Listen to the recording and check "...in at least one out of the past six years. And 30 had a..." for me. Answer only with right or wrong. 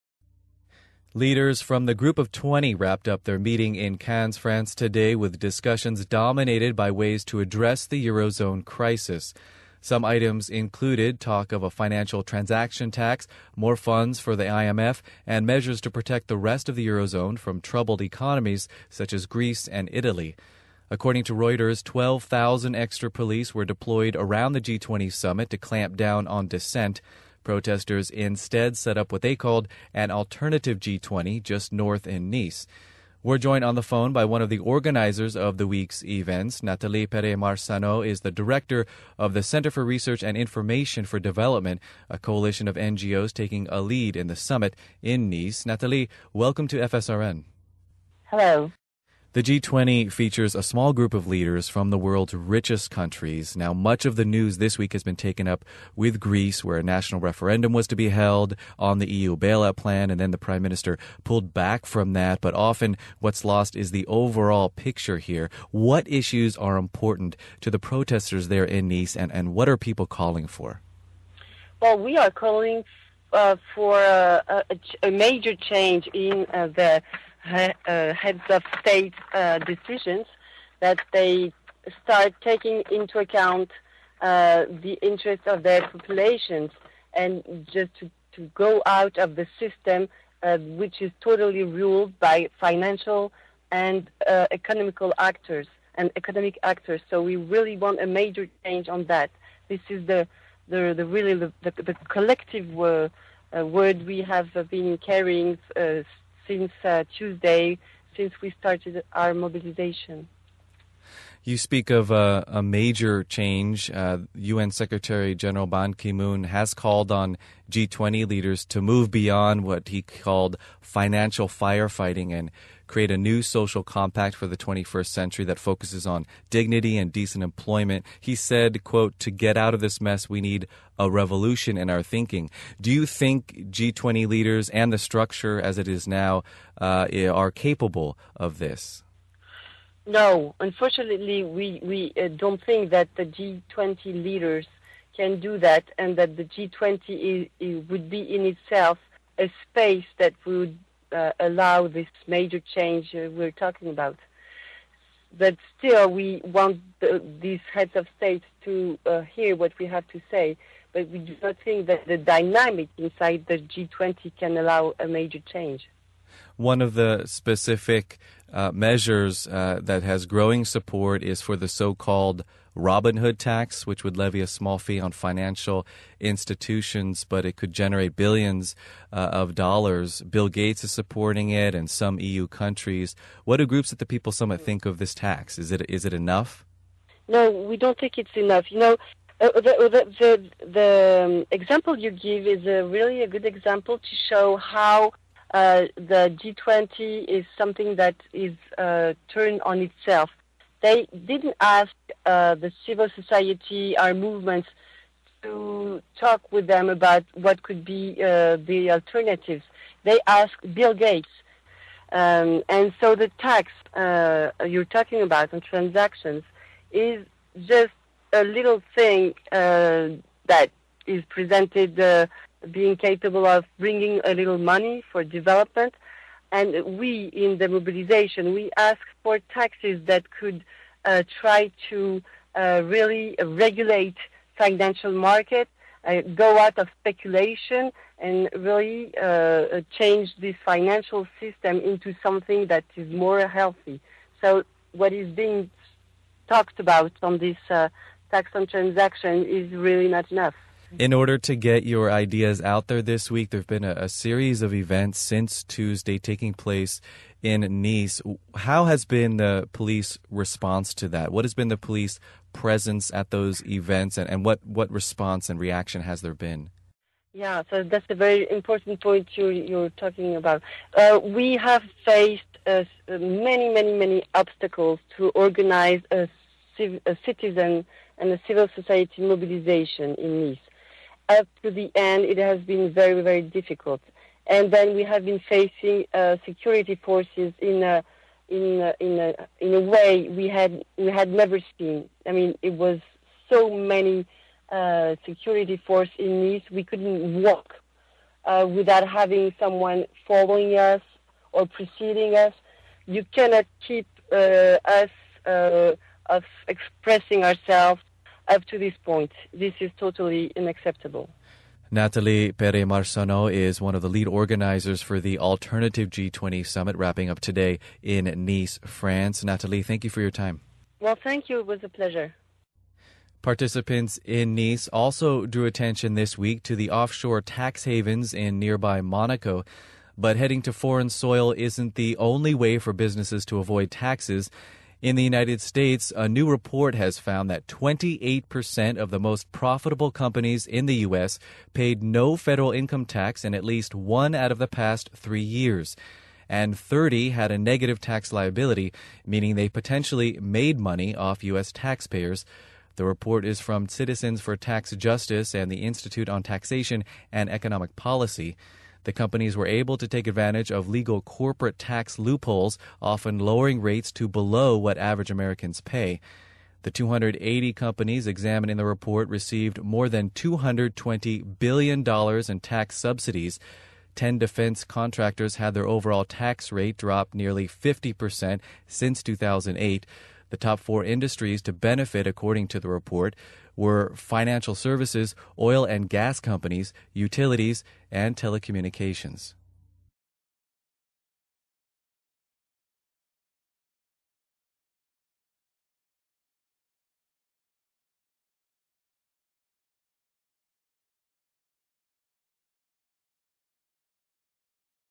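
wrong.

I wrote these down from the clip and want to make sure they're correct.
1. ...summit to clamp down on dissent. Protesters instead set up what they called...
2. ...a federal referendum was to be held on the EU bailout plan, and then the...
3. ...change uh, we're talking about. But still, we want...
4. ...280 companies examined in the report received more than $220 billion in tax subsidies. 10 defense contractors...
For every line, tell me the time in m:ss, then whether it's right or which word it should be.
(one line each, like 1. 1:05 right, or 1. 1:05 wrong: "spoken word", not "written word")
1. 0:25 right
2. 0:56 wrong: "national", not "federal"
3. 2:32 right
4. 6:06 right.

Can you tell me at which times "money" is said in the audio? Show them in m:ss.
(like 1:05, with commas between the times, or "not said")
3:44, 5:50.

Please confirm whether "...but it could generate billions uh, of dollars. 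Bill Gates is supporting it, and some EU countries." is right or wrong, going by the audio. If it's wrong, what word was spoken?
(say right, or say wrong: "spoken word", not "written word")
right.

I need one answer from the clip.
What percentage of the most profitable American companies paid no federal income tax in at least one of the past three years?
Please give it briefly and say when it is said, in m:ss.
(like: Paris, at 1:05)
28%, at 5:37.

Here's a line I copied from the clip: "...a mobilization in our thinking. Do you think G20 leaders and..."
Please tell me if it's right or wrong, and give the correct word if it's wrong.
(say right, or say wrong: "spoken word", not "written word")
wrong: "revolution", not "mobilization".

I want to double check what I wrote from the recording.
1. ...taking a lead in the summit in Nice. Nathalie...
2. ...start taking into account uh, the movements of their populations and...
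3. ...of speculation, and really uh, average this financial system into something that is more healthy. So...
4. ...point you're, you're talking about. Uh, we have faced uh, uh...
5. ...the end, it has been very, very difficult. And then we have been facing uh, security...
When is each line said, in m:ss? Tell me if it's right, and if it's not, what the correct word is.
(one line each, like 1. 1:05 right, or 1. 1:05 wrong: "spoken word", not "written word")
1. 0:43 right
2. 1:22 wrong: "interests", not "movements"
3. 3:56 wrong: "change", not "average"
4. 4:29 right
5. 4:41 right.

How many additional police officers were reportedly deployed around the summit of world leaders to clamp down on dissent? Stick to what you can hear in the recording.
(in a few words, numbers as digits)
12,000.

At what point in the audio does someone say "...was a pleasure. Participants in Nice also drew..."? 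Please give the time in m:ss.
5:21.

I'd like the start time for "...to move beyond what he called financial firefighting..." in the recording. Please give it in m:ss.
1:58.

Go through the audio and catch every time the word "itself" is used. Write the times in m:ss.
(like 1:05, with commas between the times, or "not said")
2:28, 3:19.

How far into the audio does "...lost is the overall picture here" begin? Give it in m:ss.
1:03.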